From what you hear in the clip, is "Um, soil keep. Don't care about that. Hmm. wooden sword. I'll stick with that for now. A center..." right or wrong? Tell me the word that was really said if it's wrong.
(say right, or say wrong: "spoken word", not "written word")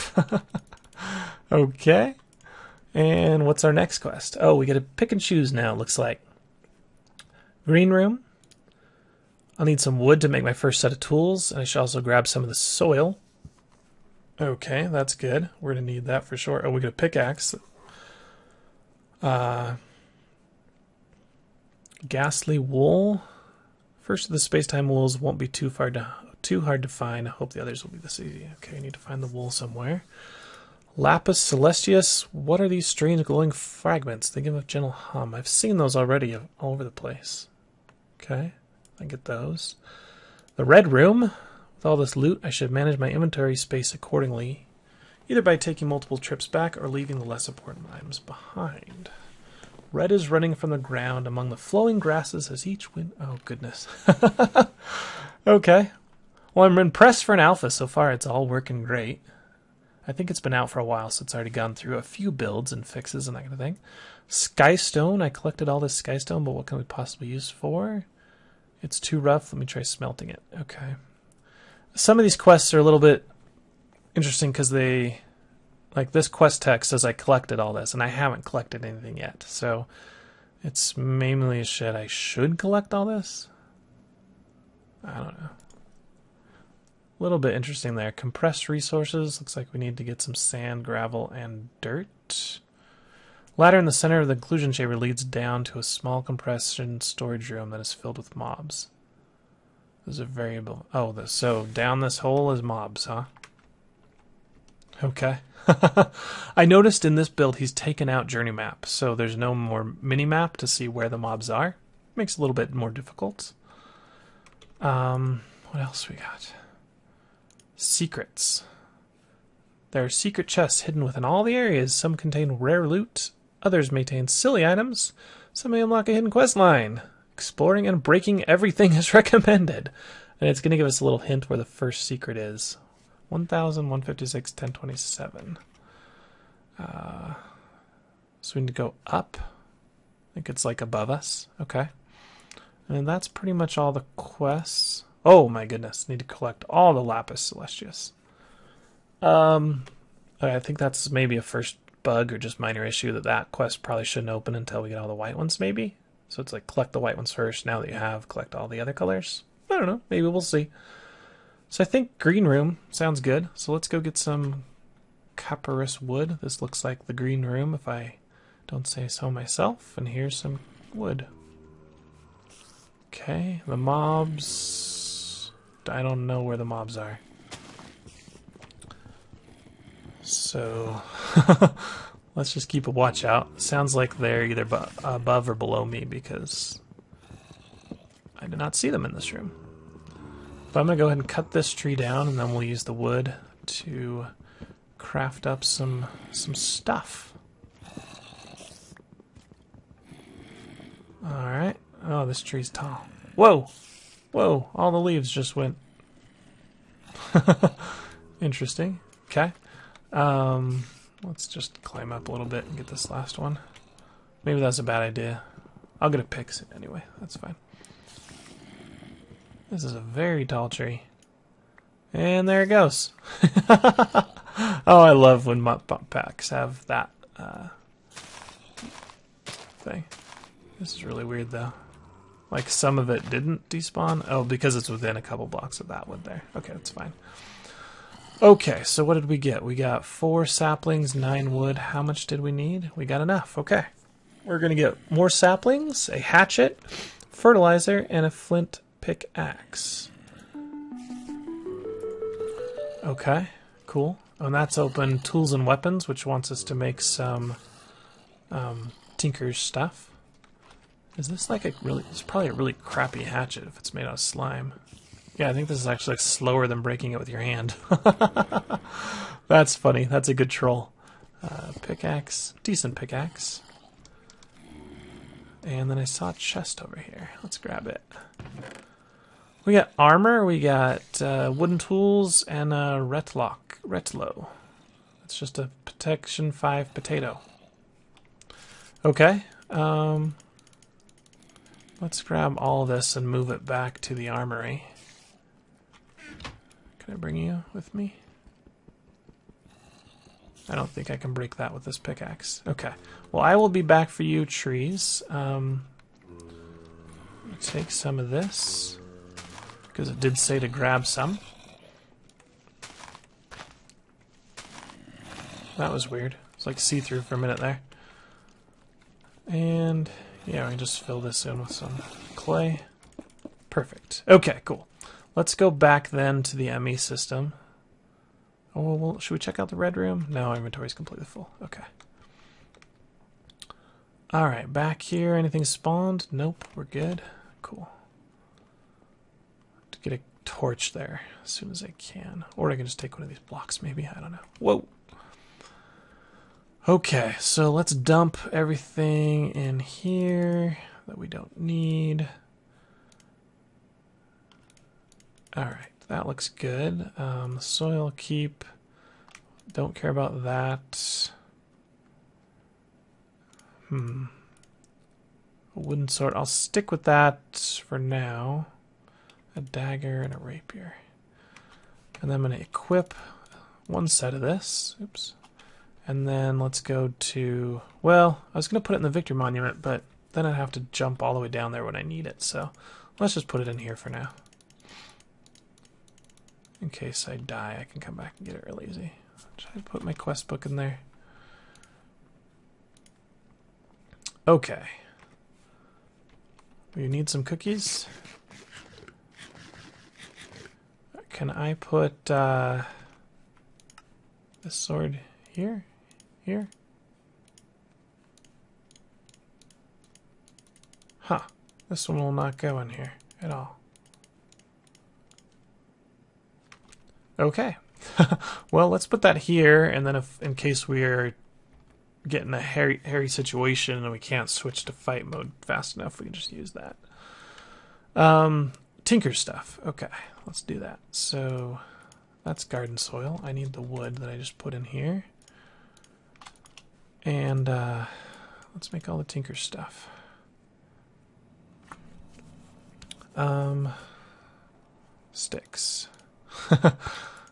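wrong: "dagger", not "center".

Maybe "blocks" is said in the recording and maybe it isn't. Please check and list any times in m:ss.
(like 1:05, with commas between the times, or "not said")
3:55, 5:43.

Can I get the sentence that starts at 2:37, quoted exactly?
Now that you have, collect all the other colors.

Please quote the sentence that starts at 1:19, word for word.
So it's mainly a shit I should collect all this.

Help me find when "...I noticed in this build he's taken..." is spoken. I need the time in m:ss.
1:46.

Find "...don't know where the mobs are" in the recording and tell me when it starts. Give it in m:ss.
2:56.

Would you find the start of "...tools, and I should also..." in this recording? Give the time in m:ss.
0:10.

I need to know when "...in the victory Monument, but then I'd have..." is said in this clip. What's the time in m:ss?
6:18.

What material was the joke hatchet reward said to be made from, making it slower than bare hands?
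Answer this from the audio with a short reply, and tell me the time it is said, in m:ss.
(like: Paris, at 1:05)
Slime, at 4:24.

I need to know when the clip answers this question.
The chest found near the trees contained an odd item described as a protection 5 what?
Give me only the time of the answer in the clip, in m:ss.
4:46.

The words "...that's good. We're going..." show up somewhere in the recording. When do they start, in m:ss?
0:14.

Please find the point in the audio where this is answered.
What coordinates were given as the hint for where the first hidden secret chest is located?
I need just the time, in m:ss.
2:13.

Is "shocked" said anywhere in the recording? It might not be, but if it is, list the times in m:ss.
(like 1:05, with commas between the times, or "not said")
not said.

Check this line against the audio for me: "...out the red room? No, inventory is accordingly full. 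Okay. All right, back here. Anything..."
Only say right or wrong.
wrong.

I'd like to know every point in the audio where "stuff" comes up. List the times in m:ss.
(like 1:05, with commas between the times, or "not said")
3:16, 4:19, 7:09, 7:19.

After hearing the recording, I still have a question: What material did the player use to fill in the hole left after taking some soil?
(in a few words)
Clay.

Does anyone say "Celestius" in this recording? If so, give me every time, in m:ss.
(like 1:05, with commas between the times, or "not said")
0:31, 2:27.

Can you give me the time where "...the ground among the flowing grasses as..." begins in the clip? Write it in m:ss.
0:50.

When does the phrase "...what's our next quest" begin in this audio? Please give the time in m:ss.
0:03.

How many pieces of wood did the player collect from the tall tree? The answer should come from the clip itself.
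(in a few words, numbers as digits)
9.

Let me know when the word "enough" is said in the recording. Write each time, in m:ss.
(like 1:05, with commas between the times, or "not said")
4:03, 7:05.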